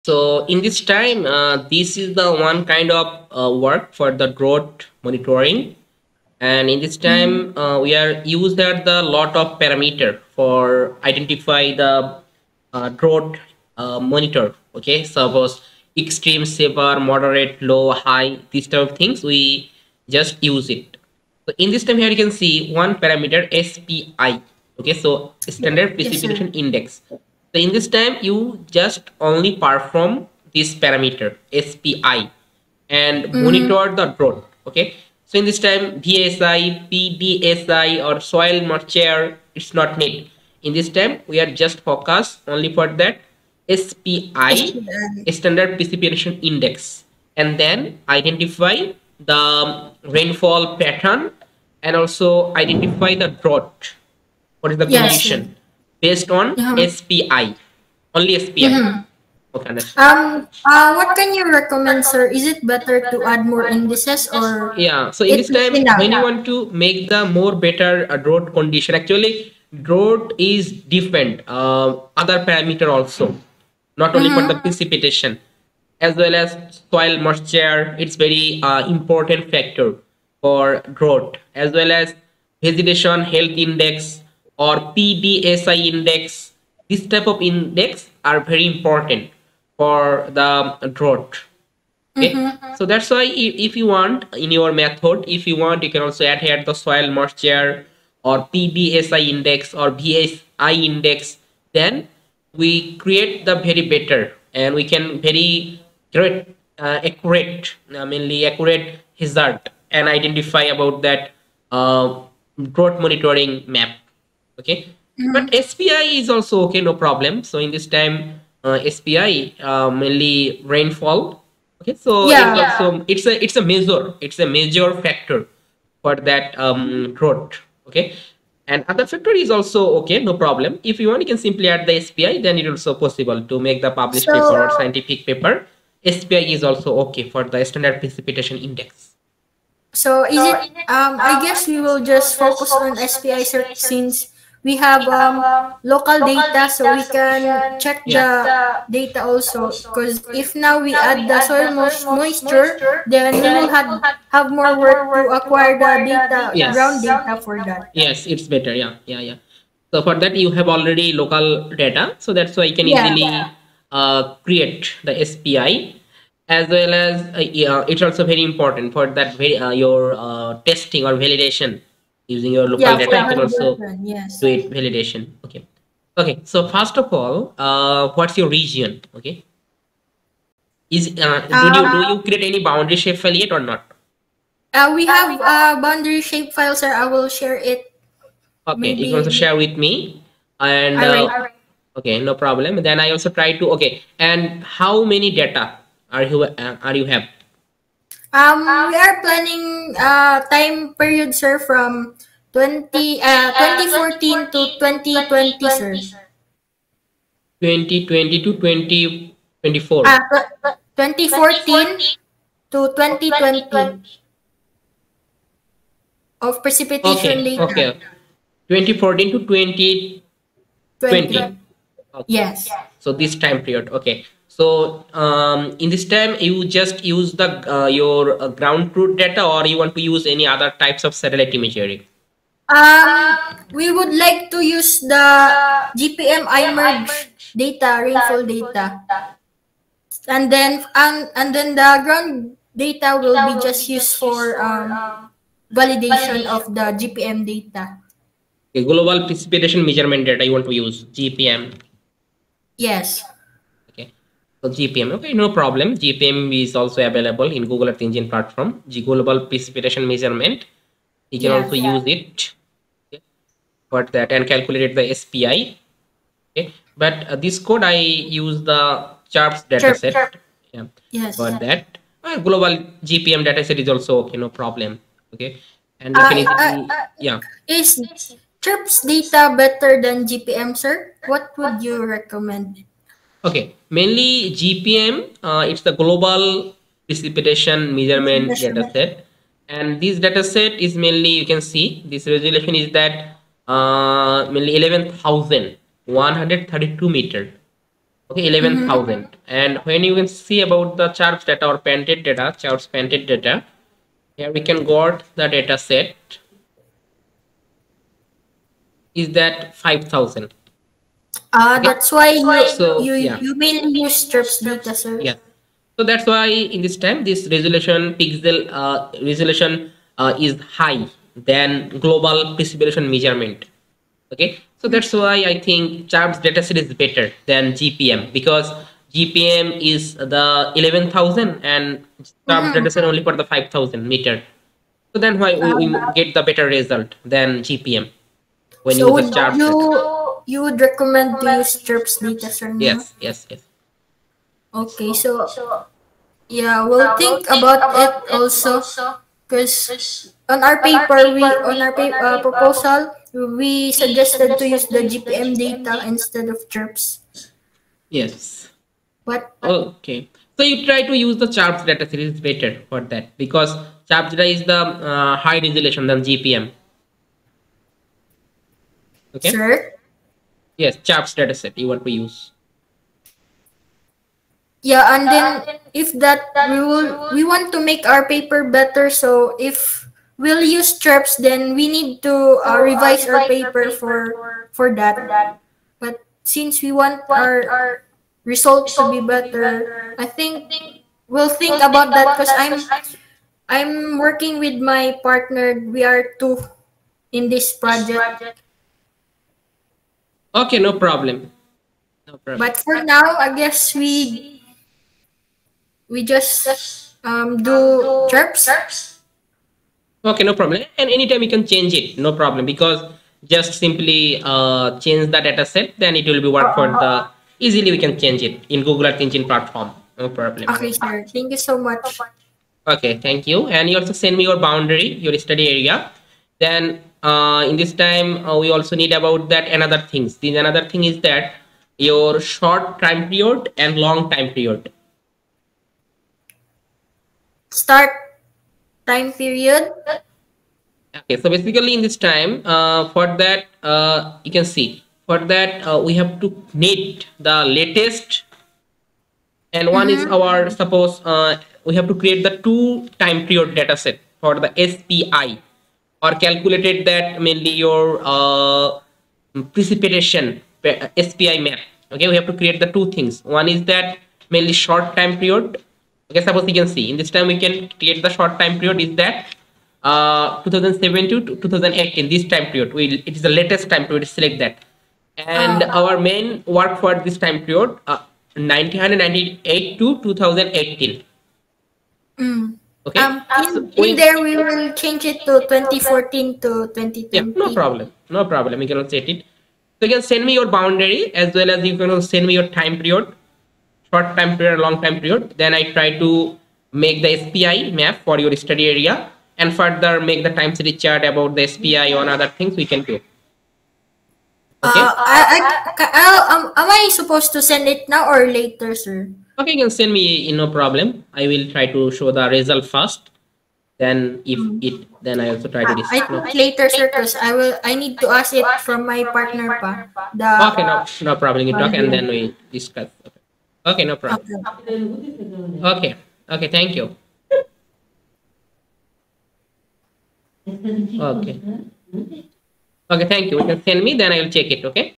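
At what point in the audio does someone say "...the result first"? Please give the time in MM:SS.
08:32.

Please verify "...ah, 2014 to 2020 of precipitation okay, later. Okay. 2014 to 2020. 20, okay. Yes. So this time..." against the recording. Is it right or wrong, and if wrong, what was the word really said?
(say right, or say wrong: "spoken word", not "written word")
right.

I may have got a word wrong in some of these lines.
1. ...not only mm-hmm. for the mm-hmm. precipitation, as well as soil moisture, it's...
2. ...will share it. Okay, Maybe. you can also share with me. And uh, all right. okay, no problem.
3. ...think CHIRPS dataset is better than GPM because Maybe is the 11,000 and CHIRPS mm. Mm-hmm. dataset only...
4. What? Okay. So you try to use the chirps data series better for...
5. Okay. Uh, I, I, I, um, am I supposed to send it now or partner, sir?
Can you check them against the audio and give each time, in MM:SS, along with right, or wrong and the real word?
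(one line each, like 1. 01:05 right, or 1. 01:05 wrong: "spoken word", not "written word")
1. 01:13 right
2. 03:07 right
3. 05:25 wrong: "GPM", not "Maybe"
4. 05:59 right
5. 08:24 wrong: "later", not "partner".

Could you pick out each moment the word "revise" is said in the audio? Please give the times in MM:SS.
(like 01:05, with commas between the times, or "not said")
06:22.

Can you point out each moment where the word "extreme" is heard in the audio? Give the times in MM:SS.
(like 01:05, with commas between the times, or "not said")
00:15.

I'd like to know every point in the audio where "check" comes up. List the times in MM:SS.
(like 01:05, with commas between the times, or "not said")
02:27, 08:54.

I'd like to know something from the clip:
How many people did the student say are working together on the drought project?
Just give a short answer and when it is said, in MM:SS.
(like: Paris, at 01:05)
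2, at 06:35.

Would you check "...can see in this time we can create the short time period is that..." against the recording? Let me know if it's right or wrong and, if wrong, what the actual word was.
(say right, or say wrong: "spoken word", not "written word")
right.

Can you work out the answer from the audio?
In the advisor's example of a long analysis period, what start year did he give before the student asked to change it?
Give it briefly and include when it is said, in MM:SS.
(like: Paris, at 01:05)
1998, at 07:58.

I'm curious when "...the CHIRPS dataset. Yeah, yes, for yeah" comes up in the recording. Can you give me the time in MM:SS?
04:28.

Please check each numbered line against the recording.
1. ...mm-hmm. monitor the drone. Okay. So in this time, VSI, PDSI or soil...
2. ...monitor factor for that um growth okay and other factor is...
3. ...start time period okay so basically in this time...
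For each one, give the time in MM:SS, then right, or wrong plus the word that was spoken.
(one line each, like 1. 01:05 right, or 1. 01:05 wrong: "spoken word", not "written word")
1. 00:33 right
2. 02:04 wrong: "major", not "monitor"
3. 07:17 right.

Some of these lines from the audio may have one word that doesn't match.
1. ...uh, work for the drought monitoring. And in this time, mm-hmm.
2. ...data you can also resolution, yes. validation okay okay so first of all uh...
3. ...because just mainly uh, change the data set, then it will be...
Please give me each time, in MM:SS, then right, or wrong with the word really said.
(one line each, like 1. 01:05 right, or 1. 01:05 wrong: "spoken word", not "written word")
1. 00:03 right
2. 02:52 wrong: "version", not "resolution"
3. 06:52 wrong: "simply", not "mainly".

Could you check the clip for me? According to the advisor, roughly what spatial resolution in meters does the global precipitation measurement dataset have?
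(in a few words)
11,132 meters.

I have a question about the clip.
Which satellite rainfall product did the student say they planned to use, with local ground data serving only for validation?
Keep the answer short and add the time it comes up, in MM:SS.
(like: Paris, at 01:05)
GPM IMERG, at 03:55.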